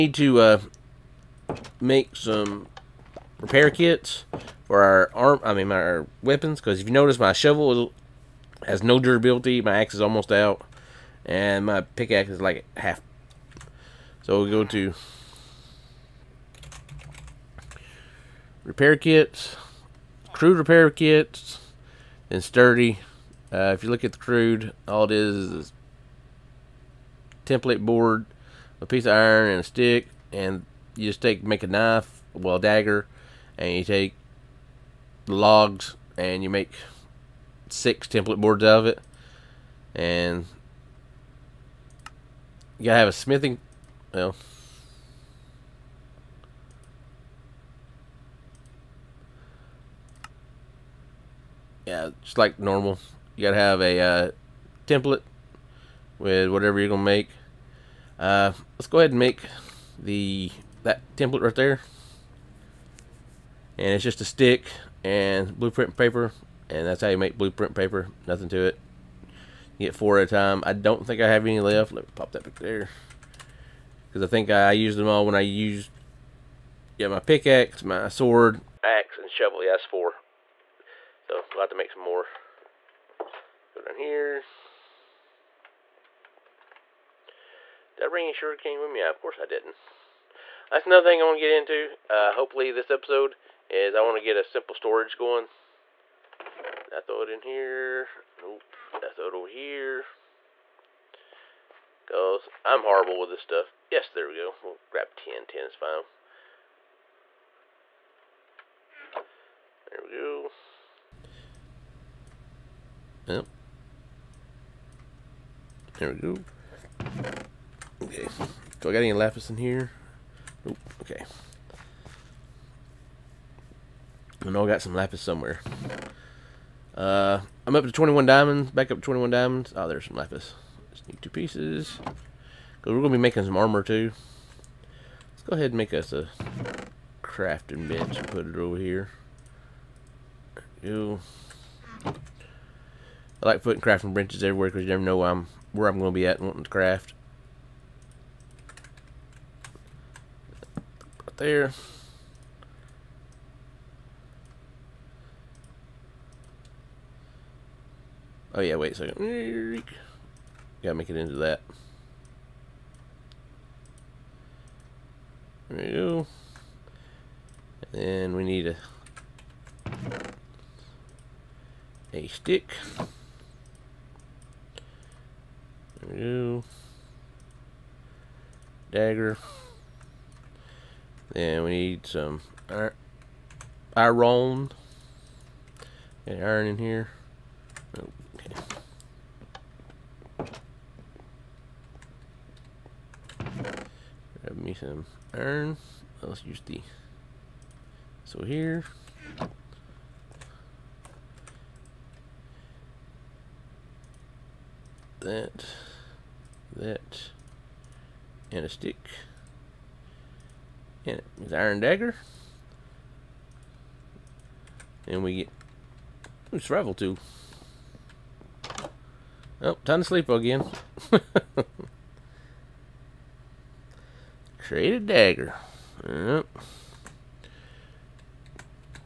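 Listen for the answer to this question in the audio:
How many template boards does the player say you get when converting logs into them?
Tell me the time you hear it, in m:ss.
0:37.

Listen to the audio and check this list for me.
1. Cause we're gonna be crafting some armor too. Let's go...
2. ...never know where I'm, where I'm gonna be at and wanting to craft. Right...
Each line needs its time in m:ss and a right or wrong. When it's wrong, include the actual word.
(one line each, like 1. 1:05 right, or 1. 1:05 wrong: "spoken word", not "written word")
1. 2:12 wrong: "making", not "crafting"
2. 2:24 right.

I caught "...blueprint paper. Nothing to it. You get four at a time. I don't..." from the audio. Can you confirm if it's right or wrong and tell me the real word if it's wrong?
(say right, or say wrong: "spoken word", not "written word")
right.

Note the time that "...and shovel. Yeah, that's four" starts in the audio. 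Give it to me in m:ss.
1:19.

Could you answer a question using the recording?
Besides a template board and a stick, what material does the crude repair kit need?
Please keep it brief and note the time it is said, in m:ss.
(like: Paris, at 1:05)
A piece of iron, at 0:28.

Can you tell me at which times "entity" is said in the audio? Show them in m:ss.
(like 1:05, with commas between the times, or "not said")
not said.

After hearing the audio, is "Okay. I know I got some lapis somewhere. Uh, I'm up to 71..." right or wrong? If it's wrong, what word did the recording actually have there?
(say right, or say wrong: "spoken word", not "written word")
wrong: "21", not "71".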